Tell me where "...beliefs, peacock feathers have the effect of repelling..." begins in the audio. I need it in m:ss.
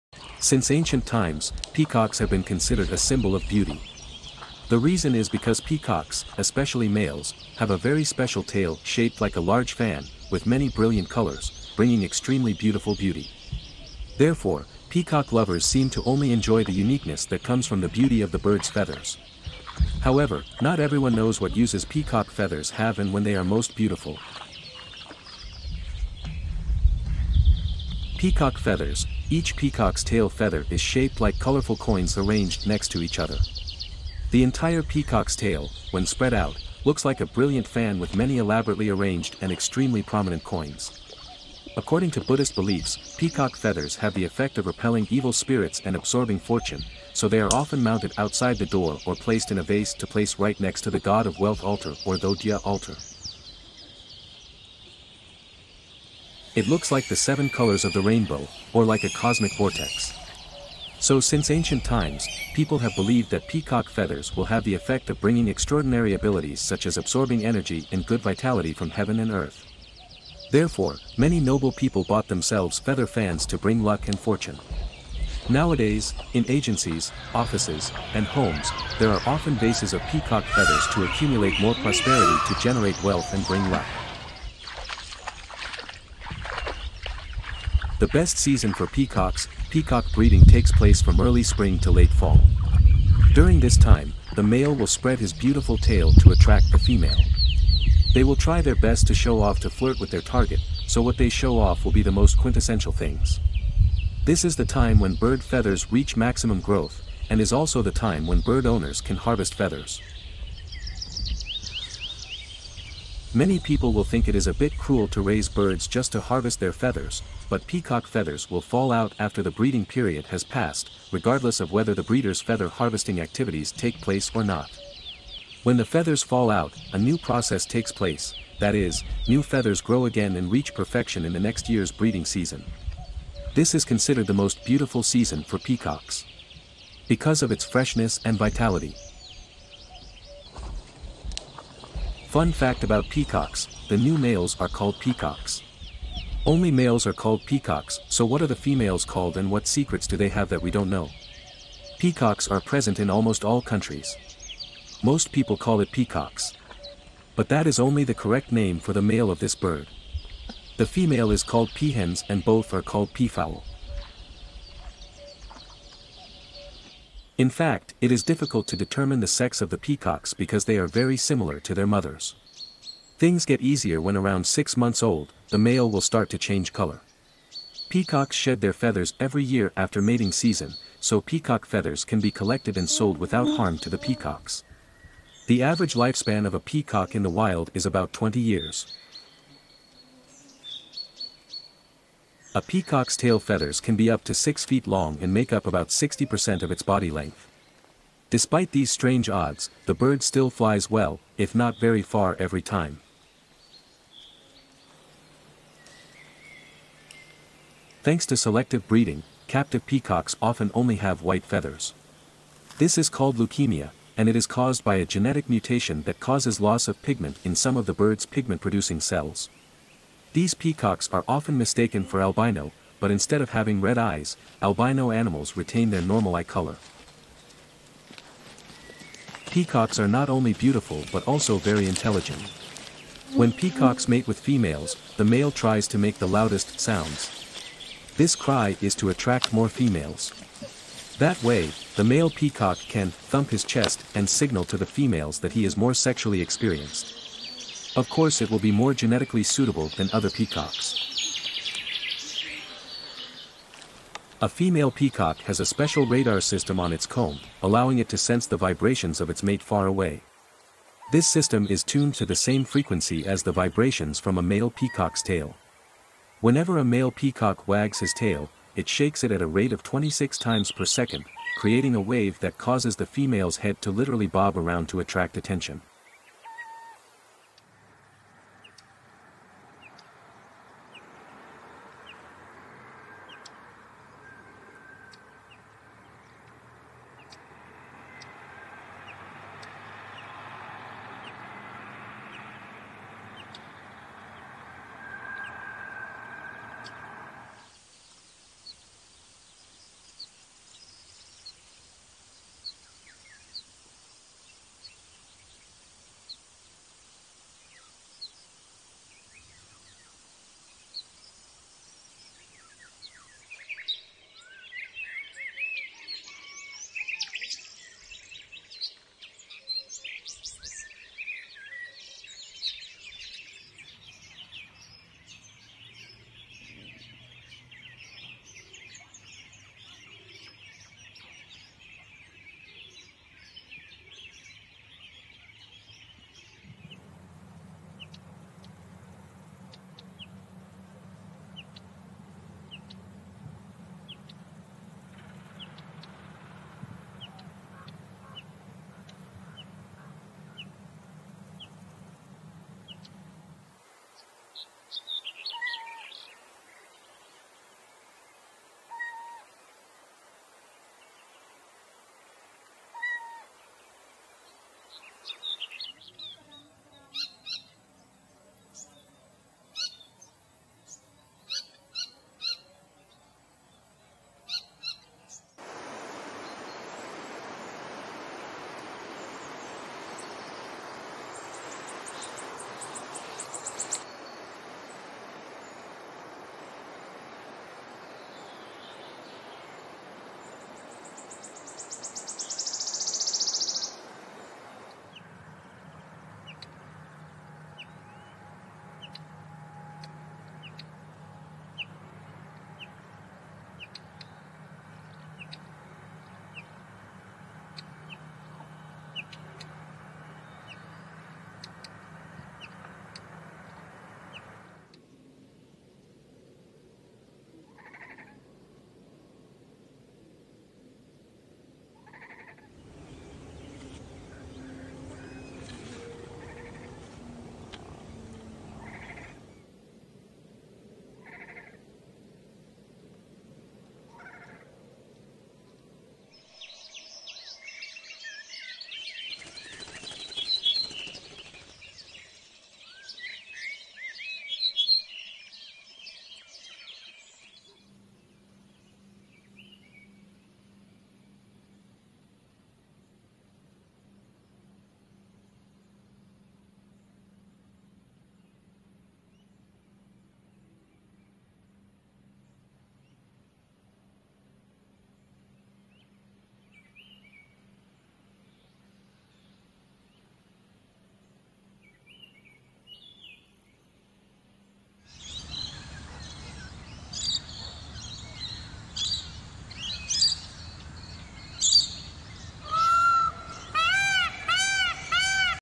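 0:42.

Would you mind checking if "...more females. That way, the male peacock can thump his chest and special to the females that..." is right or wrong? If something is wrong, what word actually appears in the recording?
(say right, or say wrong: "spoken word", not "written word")
wrong: "signal", not "special".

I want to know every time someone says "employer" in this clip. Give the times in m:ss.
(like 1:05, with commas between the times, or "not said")
not said.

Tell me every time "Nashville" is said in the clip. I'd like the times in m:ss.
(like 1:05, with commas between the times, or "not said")
not said.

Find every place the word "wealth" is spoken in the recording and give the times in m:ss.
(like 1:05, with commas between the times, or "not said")
0:51, 1:23.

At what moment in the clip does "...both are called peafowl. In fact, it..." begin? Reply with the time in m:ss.
2:42.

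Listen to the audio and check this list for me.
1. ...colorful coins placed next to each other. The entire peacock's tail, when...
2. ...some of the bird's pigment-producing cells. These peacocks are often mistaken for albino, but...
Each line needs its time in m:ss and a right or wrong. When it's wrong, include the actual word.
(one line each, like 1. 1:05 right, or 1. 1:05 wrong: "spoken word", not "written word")
1. 0:31 wrong: "arranged", not "placed"
2. 3:37 right.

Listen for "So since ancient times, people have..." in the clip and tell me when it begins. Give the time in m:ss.
1:00.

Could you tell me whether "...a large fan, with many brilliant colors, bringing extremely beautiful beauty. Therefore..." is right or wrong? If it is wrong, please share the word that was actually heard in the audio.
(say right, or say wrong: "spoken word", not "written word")
right.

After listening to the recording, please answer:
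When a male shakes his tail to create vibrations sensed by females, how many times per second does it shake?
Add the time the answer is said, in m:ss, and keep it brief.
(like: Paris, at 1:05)
26, at 4:29.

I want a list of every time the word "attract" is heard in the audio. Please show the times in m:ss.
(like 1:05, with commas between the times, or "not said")
1:36, 3:59, 4:35.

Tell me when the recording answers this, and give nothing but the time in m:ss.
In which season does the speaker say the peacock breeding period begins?
1:31.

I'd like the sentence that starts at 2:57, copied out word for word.
Peacocks shed their feathers every year after mating season, so peacock feathers can be collected and sold without harm to the peacocks.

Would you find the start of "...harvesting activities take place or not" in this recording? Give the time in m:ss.
2:02.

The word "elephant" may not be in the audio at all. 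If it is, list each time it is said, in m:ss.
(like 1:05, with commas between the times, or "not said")
not said.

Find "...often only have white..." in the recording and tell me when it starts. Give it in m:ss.
3:30.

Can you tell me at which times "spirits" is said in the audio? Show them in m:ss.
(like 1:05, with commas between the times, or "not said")
0:45.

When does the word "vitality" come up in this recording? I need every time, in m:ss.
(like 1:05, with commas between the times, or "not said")
1:08, 2:18.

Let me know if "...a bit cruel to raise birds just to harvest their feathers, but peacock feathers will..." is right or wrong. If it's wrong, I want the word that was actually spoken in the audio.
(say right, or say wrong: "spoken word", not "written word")
right.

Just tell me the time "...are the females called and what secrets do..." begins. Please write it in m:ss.
2:28.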